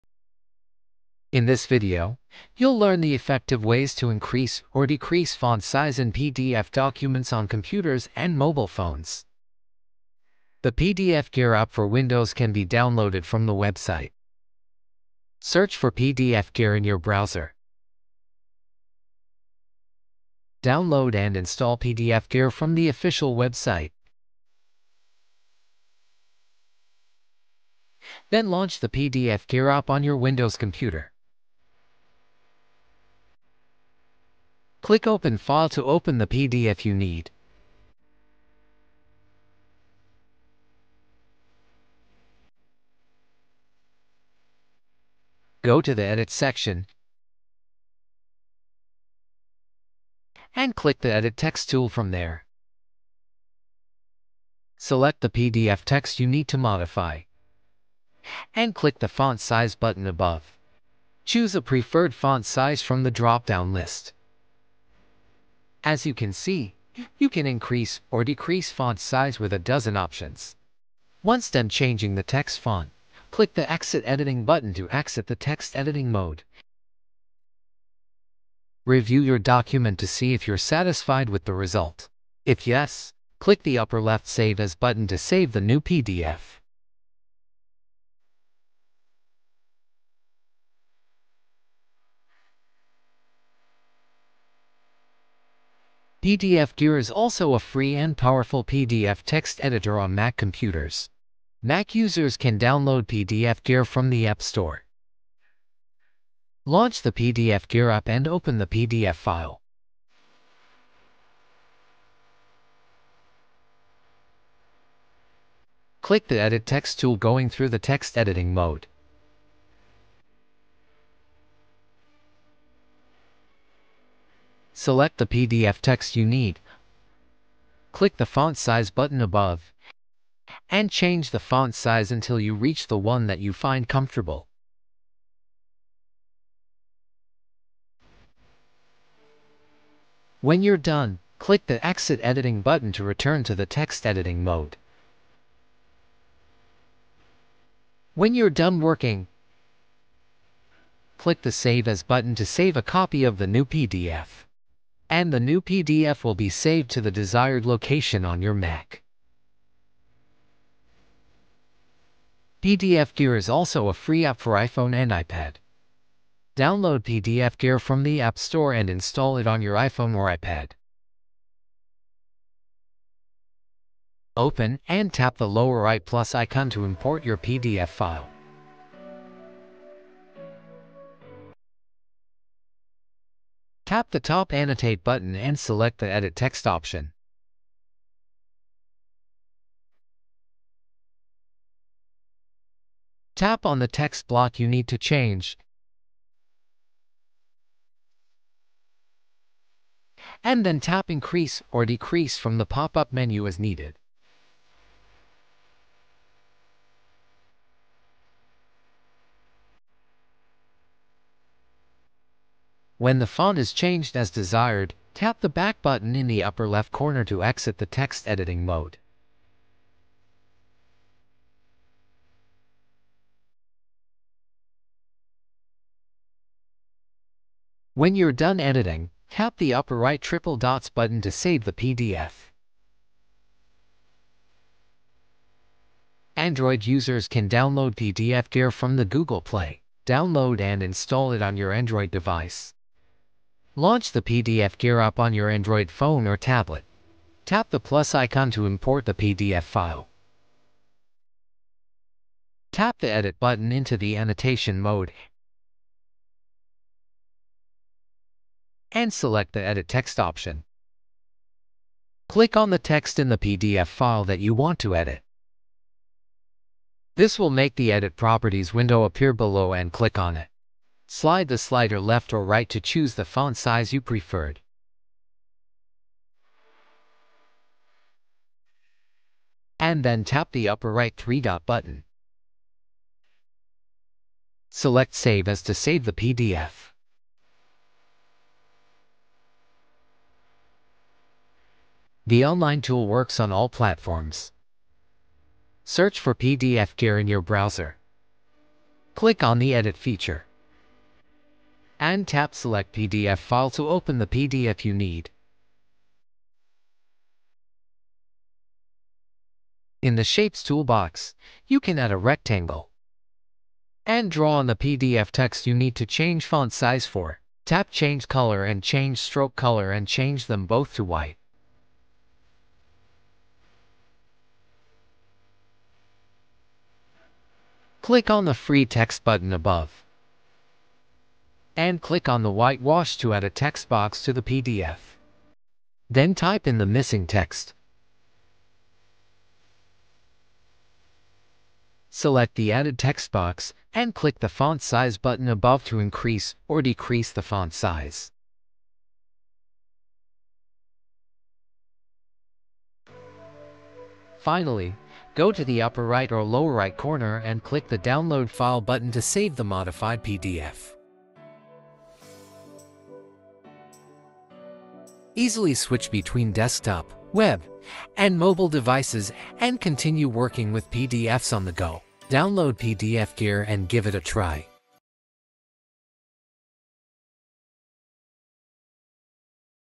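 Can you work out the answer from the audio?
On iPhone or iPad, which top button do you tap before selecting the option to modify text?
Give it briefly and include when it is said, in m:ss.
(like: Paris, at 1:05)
Annotate, at 3:04.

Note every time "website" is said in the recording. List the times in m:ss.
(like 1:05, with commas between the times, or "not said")
0:13, 0:23.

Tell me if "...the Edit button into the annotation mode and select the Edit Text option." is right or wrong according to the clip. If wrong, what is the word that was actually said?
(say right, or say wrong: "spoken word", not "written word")
right.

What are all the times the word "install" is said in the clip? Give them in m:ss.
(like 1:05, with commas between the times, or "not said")
0:21, 2:48, 4:00.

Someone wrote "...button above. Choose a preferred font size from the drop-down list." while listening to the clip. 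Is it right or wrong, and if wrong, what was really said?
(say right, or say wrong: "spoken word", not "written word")
right.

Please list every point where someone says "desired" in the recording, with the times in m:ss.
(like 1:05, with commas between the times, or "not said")
2:37, 3:34.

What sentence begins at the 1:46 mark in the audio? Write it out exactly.
Launch the PDFgear app and open the PDF file.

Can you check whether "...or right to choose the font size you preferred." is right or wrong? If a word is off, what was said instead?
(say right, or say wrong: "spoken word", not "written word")
right.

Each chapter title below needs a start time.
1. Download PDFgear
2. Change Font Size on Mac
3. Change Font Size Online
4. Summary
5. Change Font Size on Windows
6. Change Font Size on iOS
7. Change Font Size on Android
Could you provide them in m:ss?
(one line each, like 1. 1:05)
1. 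0:11
2. 1:38
3. 4:54
4. 5:15
5. 0:34
6. 2:44
7. 3:58.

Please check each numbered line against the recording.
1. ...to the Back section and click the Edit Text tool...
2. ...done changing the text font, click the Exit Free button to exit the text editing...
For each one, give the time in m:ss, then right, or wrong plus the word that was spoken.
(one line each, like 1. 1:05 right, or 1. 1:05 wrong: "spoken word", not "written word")
1. 0:45 wrong: "Edit", not "Back"
2. 1:11 wrong: "Editing", not "Free".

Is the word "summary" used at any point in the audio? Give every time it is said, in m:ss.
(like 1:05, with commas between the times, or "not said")
not said.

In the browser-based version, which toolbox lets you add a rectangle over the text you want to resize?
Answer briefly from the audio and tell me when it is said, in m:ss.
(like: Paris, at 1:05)
Shapes, at 5:10.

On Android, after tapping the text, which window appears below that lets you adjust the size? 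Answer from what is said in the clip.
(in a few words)
Edit Properties.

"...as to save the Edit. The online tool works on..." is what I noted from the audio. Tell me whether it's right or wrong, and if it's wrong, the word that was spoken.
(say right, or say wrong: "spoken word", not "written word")
wrong: "PDF", not "Edit".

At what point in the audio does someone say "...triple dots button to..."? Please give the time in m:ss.
3:50.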